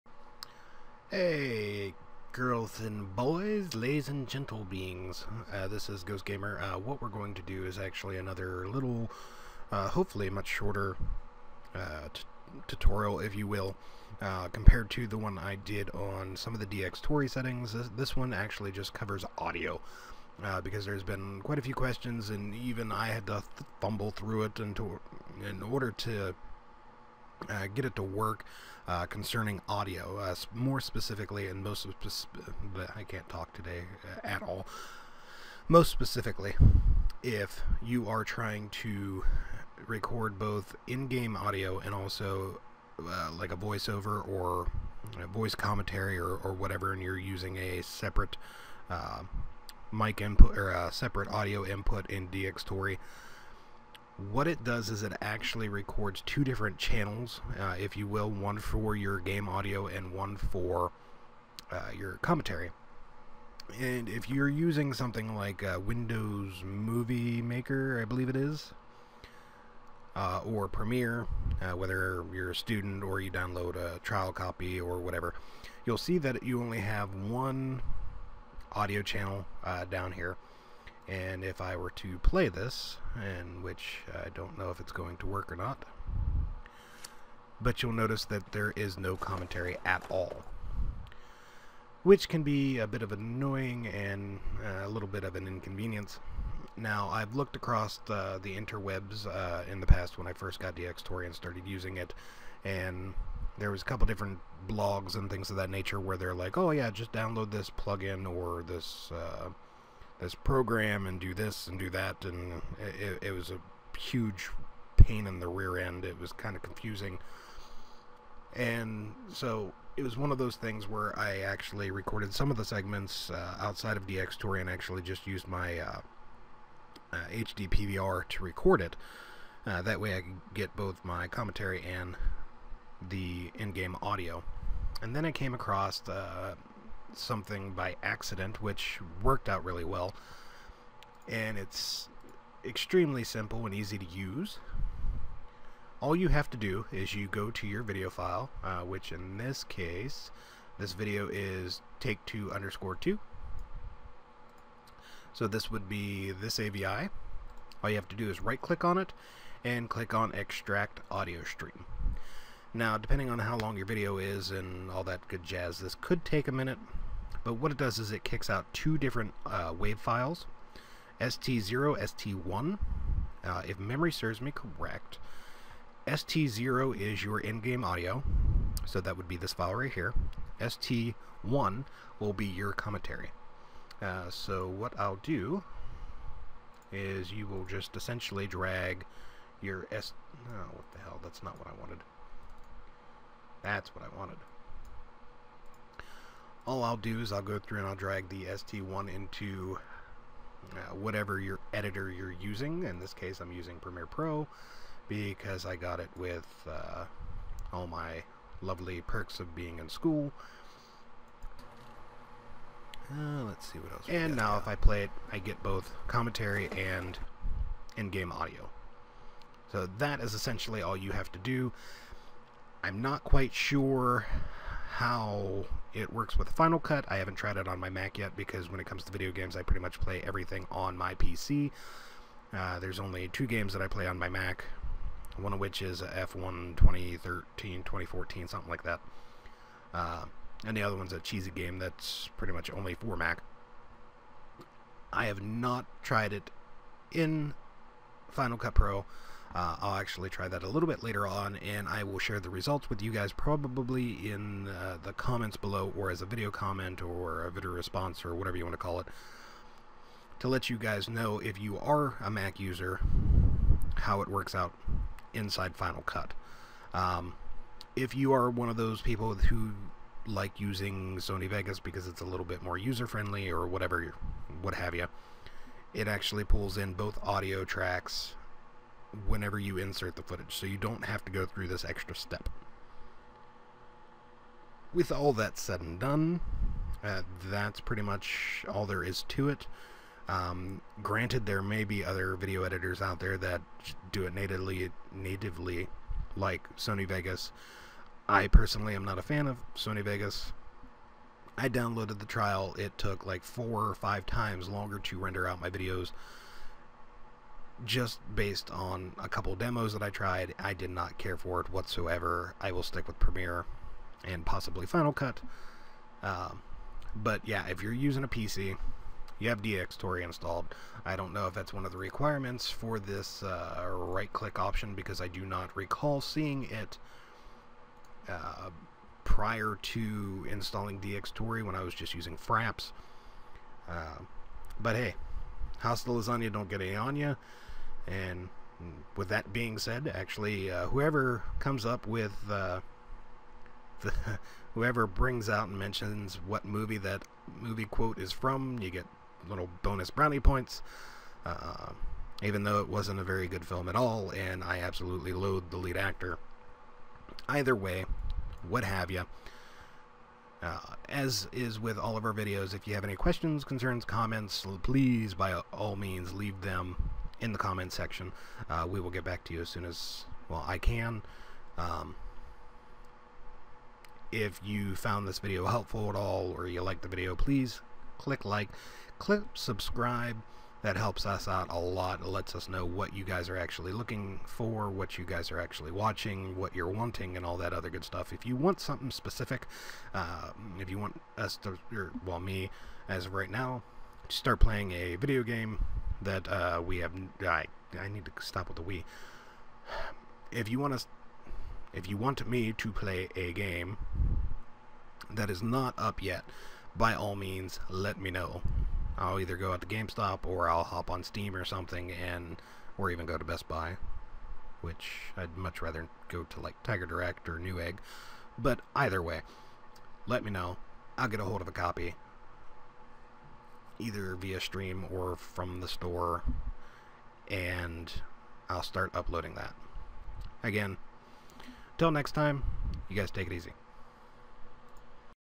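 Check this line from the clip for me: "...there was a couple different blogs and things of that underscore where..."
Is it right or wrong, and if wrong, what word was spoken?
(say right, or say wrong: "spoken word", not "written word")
wrong: "nature", not "underscore".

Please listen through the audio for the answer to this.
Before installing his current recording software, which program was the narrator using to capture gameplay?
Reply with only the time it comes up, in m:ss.
5:32.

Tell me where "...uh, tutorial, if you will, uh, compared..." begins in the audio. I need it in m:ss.
0:11.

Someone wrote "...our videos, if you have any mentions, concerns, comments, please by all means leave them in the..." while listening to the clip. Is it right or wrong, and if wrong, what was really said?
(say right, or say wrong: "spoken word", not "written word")
wrong: "questions", not "mentions".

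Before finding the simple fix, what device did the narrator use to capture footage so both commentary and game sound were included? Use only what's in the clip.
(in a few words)
HD PVR.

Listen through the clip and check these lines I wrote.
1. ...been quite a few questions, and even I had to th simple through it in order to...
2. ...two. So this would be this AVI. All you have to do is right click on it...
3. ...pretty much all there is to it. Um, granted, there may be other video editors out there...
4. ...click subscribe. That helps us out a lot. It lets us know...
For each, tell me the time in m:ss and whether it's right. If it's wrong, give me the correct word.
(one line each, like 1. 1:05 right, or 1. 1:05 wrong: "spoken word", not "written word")
1. 0:21 wrong: "fumble", not "simple"
2. 2:32 right
3. 4:47 right
4. 6:19 right.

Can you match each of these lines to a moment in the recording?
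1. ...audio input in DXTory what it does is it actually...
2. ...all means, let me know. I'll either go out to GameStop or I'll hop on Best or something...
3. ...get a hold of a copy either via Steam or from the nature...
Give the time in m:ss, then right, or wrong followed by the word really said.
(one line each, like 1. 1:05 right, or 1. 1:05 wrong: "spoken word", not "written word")
1. 0:51 right
2. 6:47 wrong: "Steam", not "Best"
3. 7:01 wrong: "store", not "nature".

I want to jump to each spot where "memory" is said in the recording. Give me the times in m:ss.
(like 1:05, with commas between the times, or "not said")
2:53.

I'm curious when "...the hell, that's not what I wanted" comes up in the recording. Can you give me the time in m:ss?
3:10.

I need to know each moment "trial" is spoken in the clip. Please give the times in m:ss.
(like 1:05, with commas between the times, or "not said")
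1:13, 5:02.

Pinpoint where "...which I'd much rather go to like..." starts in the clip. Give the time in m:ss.
6:54.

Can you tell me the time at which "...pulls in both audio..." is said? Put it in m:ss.
4:36.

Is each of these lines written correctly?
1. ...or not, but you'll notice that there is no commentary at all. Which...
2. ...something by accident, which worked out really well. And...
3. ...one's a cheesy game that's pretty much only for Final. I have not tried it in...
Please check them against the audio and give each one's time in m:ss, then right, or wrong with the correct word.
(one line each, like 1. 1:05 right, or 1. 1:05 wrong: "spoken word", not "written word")
1. 1:25 right
2. 2:17 right
3. 4:00 wrong: "Mac", not "Final".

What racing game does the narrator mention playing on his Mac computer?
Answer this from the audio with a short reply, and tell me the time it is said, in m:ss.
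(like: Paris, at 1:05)
F1 2013, at 3:56.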